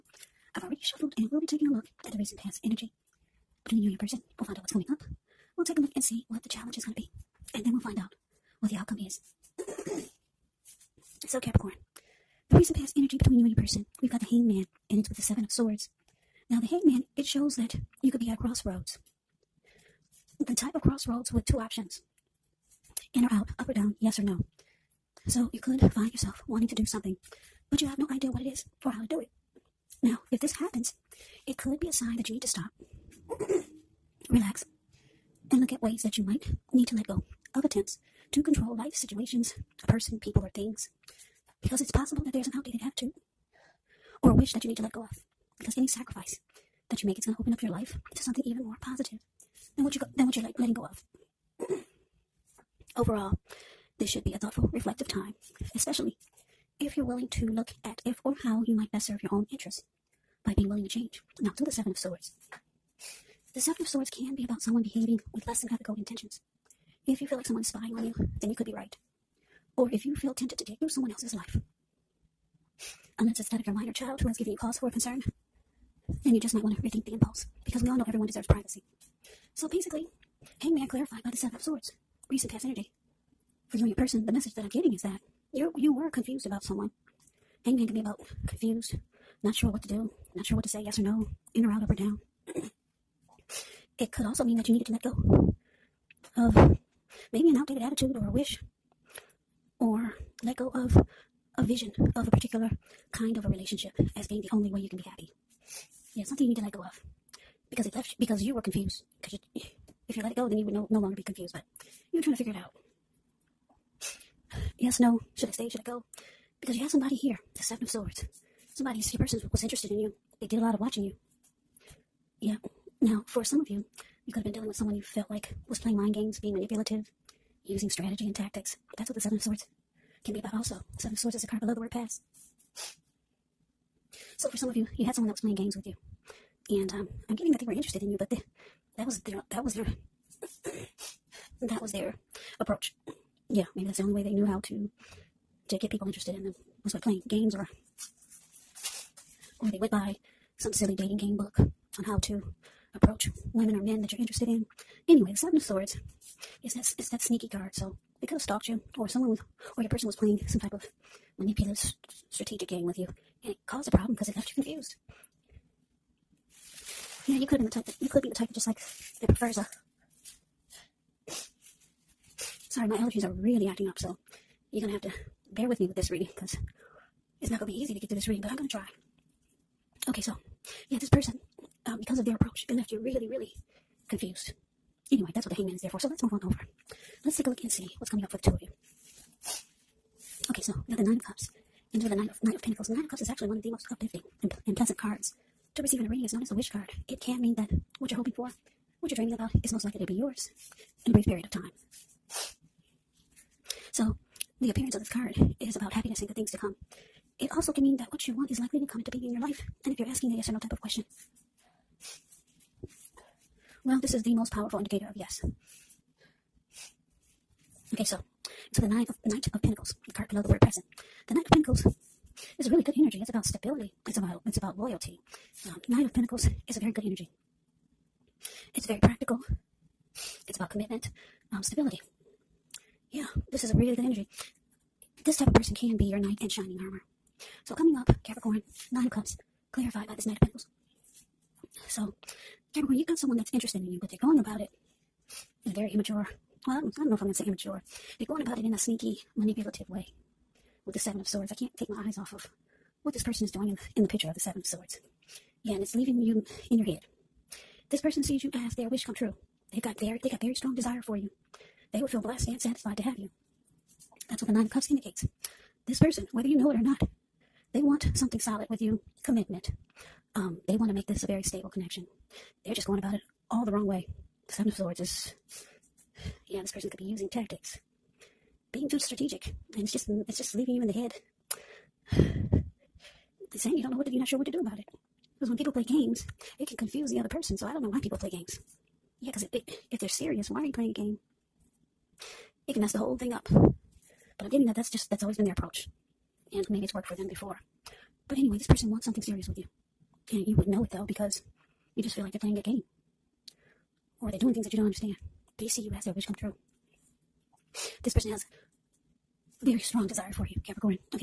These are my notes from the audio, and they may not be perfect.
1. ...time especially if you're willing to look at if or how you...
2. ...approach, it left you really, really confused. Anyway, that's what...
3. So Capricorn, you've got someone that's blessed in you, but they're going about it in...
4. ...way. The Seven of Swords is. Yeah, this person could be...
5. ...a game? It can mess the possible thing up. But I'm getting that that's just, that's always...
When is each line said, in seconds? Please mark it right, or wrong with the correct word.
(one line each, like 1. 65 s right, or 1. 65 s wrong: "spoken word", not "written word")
1. 55 s right
2. 182 s right
3. 241 s wrong: "interested", not "blessed"
4. 273 s right
5. 290 s wrong: "whole", not "possible".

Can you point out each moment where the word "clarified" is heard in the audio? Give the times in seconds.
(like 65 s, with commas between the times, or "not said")
80 s, 239 s.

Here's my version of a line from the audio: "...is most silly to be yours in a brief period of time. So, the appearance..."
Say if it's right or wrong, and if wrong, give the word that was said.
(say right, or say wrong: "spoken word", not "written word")
wrong: "likely", not "silly".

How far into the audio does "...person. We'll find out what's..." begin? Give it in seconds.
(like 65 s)
3 s.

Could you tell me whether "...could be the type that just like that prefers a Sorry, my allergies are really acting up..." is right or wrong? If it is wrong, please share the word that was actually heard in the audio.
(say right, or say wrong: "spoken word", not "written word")
right.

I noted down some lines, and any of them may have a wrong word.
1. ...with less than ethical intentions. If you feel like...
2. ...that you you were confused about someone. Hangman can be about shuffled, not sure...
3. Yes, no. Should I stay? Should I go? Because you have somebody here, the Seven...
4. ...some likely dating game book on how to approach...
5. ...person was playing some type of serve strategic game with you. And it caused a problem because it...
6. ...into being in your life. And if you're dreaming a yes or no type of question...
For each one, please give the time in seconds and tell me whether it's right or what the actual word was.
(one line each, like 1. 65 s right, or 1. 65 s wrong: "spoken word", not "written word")
1. 65 s right
2. 85 s wrong: "confused", not "shuffled"
3. 114 s right
4. 150 s wrong: "silly", not "likely"
5. 159 s wrong: "manipulative", not "serve"
6. 209 s wrong: "asking", not "dreaming".